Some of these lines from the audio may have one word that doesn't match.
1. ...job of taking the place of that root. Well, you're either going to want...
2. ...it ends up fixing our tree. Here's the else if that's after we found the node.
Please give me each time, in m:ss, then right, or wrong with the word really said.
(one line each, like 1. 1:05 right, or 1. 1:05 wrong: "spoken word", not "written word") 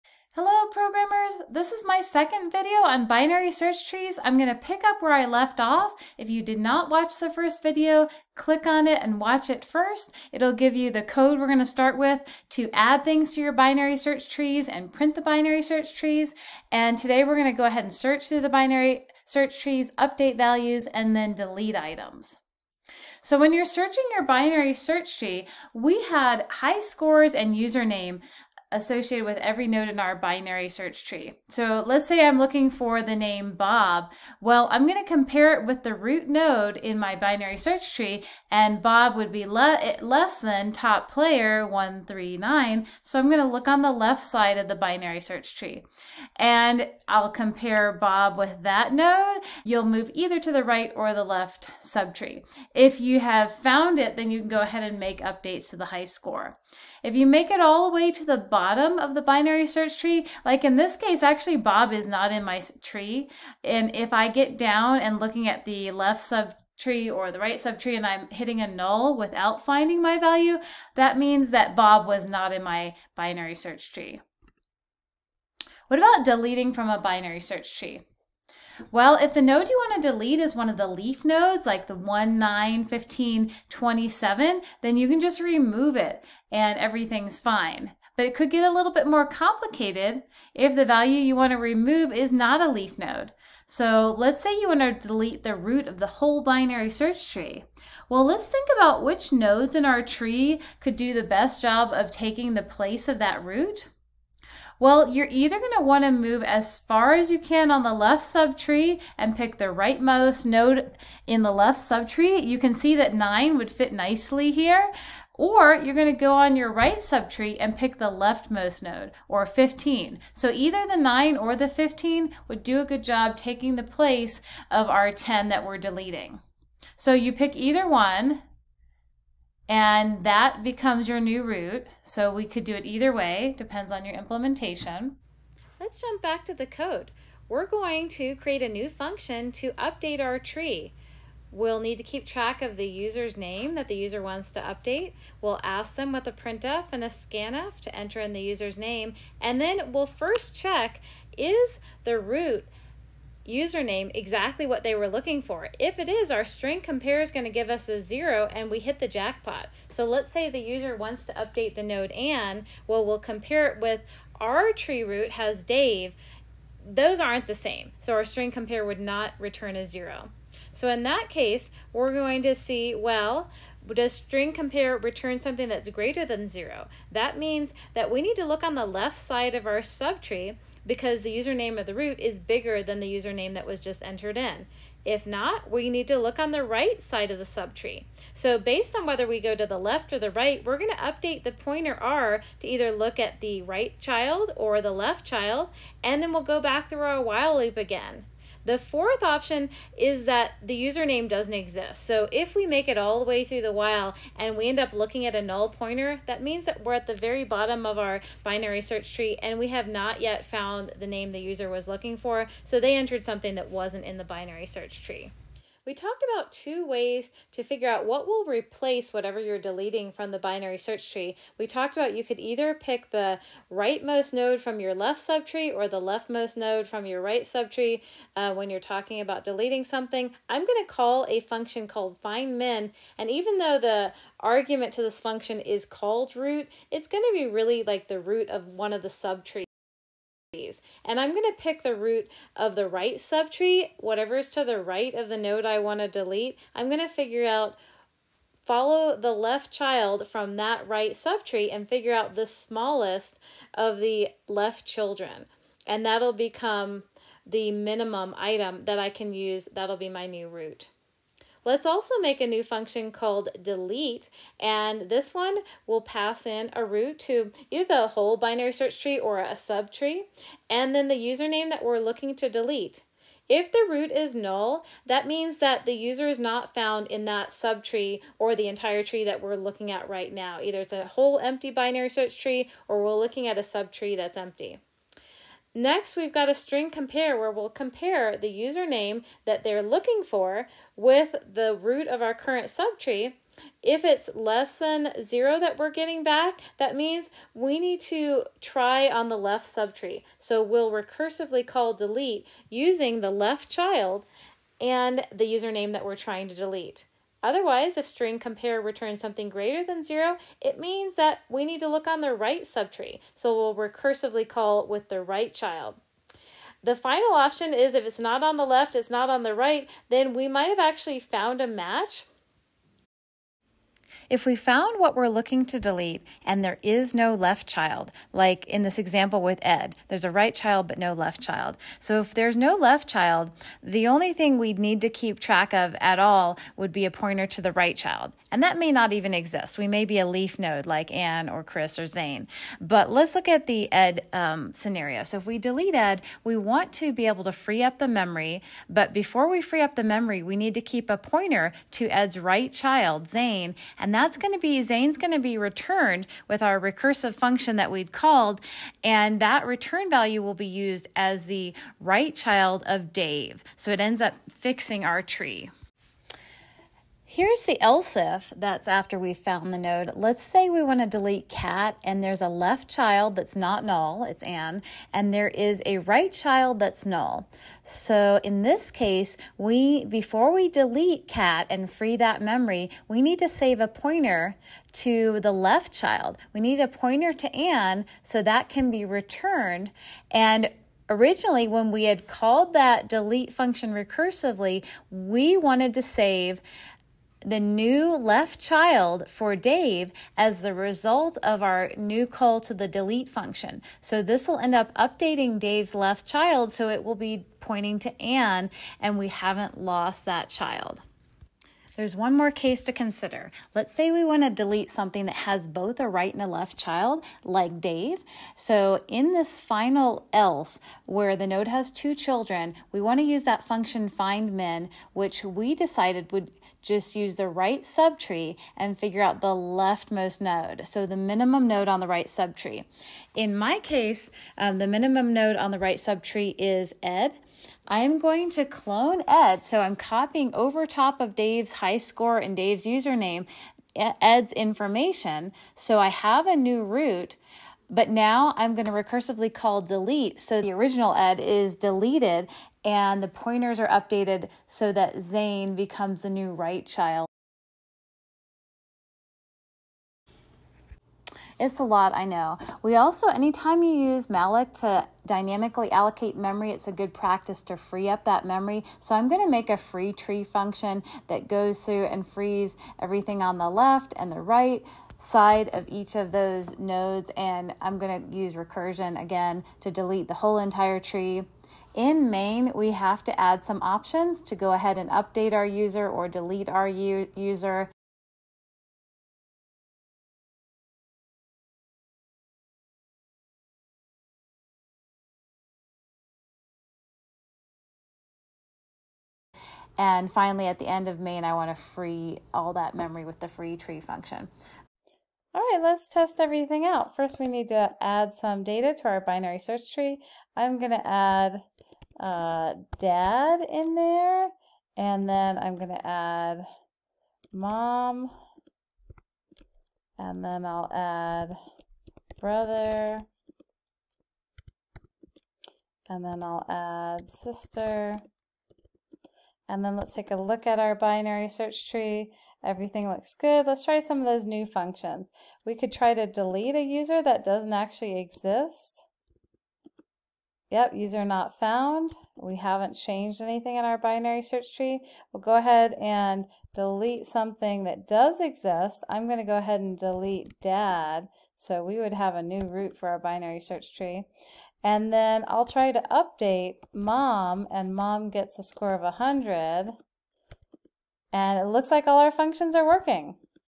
1. 1:41 right
2. 6:03 right.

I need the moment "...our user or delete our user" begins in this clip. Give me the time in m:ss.
8:05.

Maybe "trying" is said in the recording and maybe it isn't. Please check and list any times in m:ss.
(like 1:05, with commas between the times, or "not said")
5:06.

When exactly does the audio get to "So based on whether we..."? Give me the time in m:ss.
3:08.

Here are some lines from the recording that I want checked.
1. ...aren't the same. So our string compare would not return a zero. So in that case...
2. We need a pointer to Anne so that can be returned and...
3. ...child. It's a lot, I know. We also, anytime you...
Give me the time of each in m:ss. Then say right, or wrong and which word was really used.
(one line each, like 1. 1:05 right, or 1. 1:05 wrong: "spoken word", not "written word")
1. 2:47 right
2. 6:26 right
3. 7:36 right.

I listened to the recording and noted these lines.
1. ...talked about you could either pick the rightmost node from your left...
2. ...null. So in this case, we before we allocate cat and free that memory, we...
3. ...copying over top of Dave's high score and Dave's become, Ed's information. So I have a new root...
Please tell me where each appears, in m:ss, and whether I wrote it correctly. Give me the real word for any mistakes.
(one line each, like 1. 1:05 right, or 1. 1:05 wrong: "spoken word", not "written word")
1. 3:41 right
2. 6:17 wrong: "delete", not "allocate"
3. 7:19 wrong: "username", not "become".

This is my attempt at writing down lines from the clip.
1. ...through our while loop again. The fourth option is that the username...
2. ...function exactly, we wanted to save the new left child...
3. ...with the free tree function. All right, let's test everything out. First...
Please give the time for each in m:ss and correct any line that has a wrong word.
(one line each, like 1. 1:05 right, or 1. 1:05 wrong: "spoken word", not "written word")
1. 3:16 right
2. 6:33 wrong: "recursively", not "exactly"
3. 8:23 right.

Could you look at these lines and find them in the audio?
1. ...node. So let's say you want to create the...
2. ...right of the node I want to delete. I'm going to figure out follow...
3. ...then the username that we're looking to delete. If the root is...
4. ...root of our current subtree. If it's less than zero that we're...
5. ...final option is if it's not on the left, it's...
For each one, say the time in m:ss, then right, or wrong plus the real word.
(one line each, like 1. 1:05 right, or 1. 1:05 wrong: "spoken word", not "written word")
1. 1:32 wrong: "delete", not "create"
2. 4:04 right
3. 4:30 right
4. 4:51 right
5. 5:16 right.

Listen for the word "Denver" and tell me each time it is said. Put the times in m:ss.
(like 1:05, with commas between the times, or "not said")
not said.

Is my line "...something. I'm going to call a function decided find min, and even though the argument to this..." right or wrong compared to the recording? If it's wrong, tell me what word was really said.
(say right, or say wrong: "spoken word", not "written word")
wrong: "called", not "decided".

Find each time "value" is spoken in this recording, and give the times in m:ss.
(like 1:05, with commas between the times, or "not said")
0:20, 1:10, 1:30, 6:00.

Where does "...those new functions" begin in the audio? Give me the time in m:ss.
8:54.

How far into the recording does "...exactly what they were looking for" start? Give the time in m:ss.
2:34.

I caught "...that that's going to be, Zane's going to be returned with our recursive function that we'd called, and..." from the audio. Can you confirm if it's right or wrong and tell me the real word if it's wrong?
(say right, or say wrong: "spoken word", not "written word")
right.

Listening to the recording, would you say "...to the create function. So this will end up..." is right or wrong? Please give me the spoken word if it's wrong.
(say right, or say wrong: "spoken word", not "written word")
wrong: "delete", not "create".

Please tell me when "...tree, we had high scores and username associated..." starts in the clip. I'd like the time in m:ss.
0:25.